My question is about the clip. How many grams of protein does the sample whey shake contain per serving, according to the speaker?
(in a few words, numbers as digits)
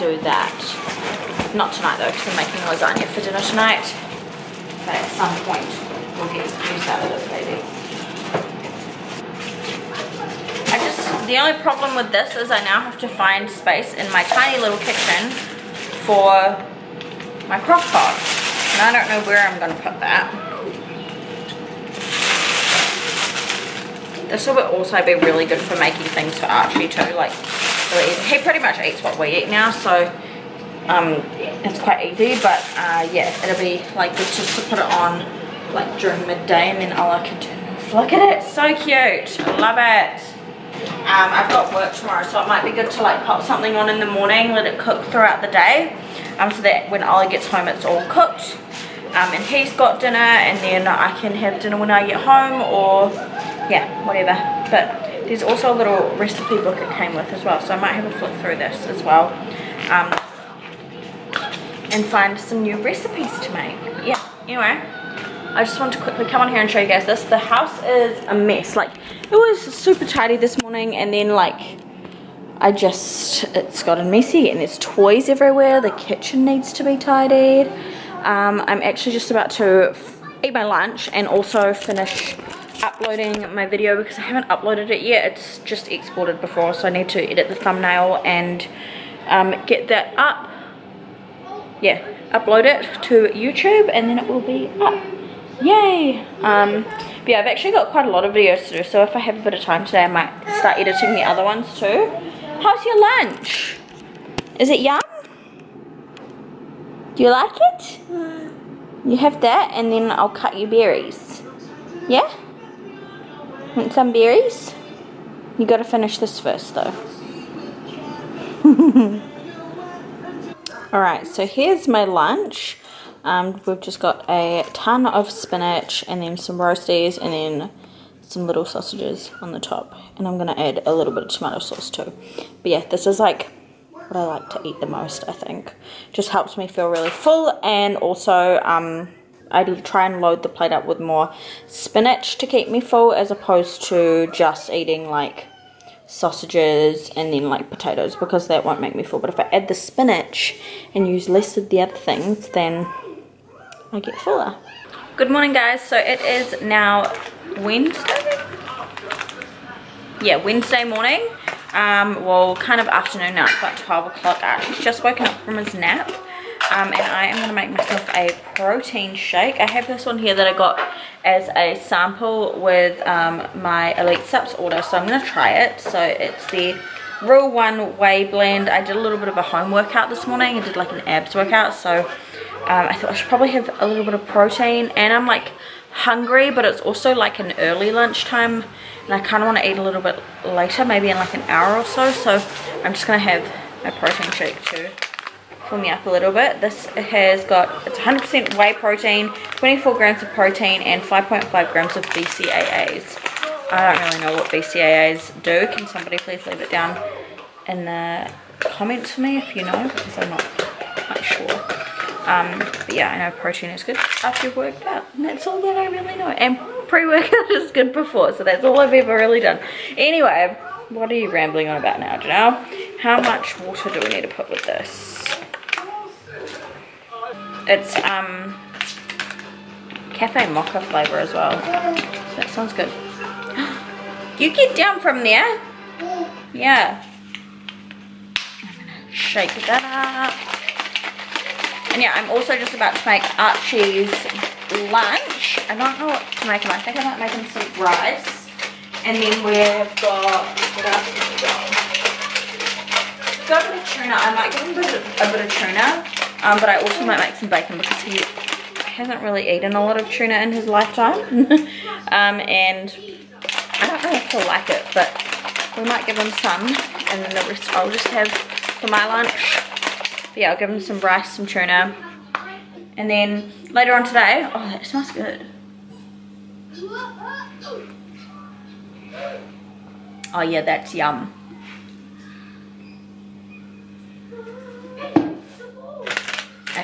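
24.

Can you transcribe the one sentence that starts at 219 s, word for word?
Anyway, what are you rambling on about now, Ginelle?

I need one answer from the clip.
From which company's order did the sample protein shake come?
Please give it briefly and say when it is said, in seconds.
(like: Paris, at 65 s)
Elite Supps, at 173 s.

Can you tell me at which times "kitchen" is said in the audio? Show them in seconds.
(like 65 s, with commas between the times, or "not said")
14 s, 75 s.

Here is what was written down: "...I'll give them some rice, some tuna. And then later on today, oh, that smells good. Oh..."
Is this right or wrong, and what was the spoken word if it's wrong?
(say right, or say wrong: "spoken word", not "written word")
right.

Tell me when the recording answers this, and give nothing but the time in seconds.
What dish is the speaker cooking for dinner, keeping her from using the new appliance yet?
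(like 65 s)
2 s.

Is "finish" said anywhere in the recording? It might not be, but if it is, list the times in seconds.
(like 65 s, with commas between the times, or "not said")
81 s, 115 s.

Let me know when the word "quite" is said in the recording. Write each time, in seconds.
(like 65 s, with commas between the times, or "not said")
31 s, 97 s, 210 s.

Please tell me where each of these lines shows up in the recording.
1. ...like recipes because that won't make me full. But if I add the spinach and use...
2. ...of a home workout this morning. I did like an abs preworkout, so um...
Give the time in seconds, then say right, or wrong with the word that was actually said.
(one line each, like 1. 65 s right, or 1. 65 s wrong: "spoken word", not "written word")
1. 147 s wrong: "potatoes", not "recipes"
2. 179 s wrong: "workout", not "preworkout".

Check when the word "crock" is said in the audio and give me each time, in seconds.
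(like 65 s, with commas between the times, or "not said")
17 s.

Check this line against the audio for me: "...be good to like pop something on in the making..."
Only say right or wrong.
wrong.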